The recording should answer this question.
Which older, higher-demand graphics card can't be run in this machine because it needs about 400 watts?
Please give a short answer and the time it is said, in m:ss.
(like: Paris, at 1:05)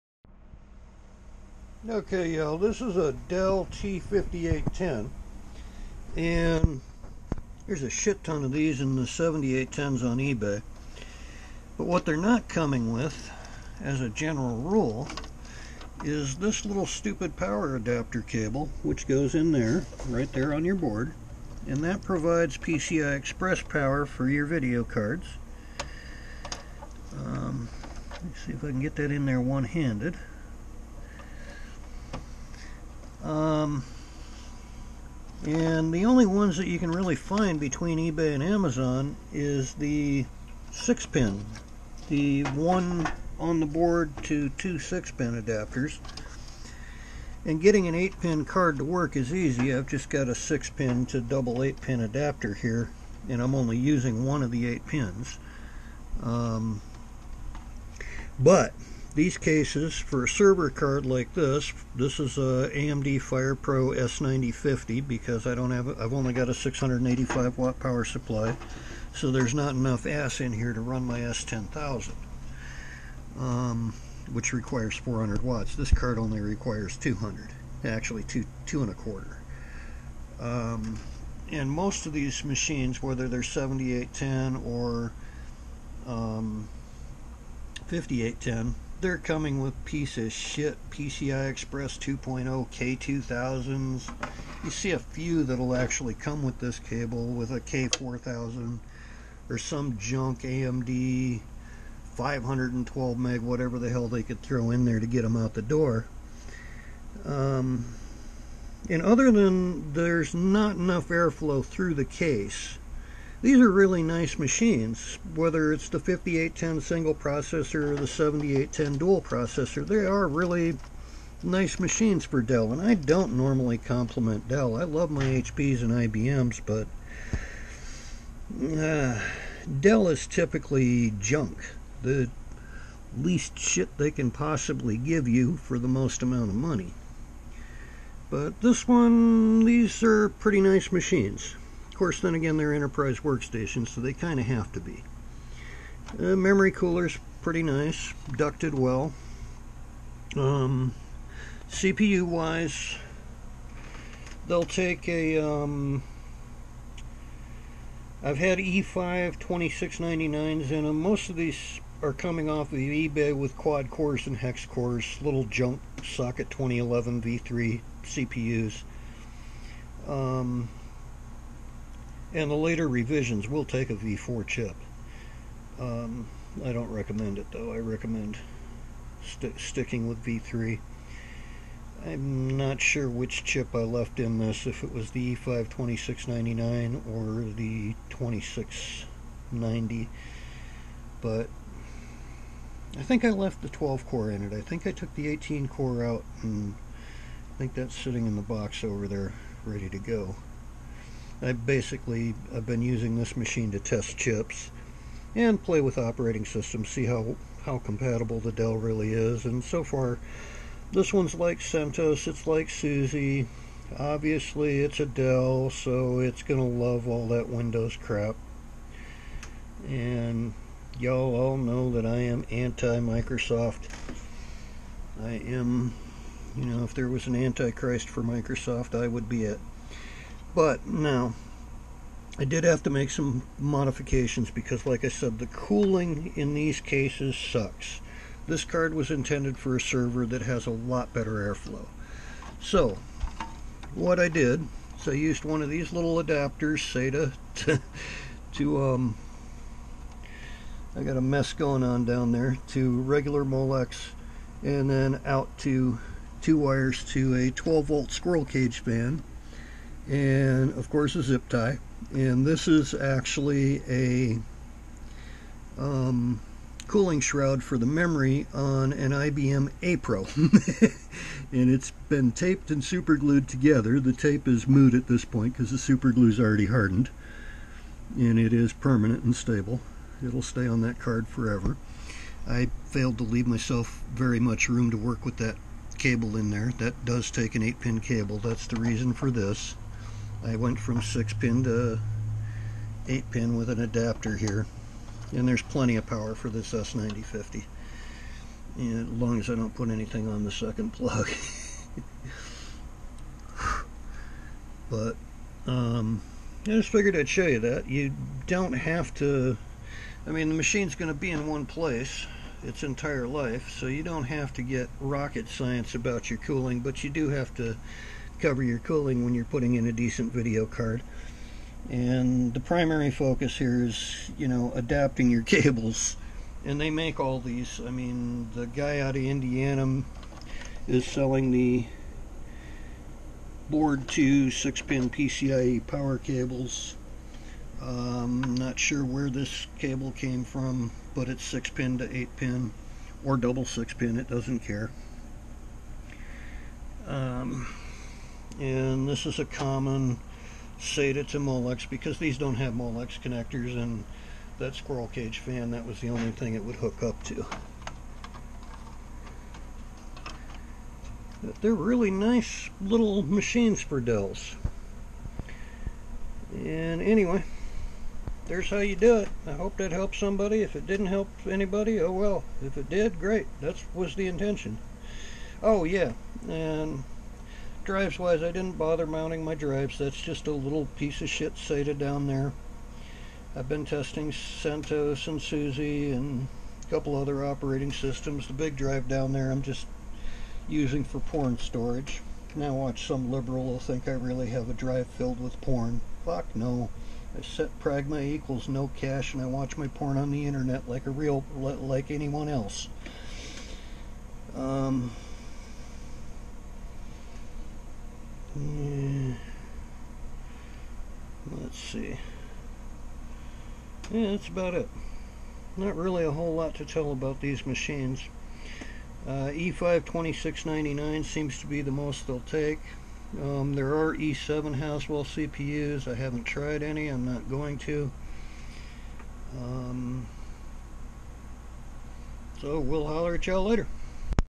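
S10000, at 1:11.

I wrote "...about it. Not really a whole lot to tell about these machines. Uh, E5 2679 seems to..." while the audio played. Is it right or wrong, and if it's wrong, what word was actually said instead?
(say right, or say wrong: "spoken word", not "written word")
wrong: "2699", not "2679".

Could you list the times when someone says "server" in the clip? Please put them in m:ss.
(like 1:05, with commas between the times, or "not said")
1:00, 3:59.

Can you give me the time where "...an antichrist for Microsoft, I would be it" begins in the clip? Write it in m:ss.
3:47.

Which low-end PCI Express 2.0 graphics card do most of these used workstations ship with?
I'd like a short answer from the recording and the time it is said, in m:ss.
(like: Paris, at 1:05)
K2000, at 1:32.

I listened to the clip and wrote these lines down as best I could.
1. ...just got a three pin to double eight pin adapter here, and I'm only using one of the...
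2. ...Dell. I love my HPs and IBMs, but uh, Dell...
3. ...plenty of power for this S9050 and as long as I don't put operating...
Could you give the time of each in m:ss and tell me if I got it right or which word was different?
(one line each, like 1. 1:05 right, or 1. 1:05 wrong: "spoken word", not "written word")
1. 0:49 wrong: "six", not "three"
2. 2:04 right
3. 4:55 wrong: "anything", not "operating".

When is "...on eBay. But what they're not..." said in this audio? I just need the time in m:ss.
0:10.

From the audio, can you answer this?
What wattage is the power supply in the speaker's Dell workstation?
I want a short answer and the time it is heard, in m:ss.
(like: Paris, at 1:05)
685 watts, at 1:06.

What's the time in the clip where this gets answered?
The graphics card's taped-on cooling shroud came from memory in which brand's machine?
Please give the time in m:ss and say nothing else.
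4:29.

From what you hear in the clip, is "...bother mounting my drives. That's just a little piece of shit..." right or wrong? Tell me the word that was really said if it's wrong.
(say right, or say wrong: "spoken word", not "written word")
right.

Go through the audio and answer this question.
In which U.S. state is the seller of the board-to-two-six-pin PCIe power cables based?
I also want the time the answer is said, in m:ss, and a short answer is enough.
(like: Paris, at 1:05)
Indiana, at 5:29.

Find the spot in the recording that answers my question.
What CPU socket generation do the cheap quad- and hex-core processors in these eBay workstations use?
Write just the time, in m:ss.
2:46.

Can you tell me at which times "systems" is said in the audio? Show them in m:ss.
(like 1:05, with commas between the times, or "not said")
3:26, 6:27.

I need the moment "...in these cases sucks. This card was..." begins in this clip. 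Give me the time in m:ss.
3:56.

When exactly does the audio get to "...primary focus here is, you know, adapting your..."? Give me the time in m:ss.
5:22.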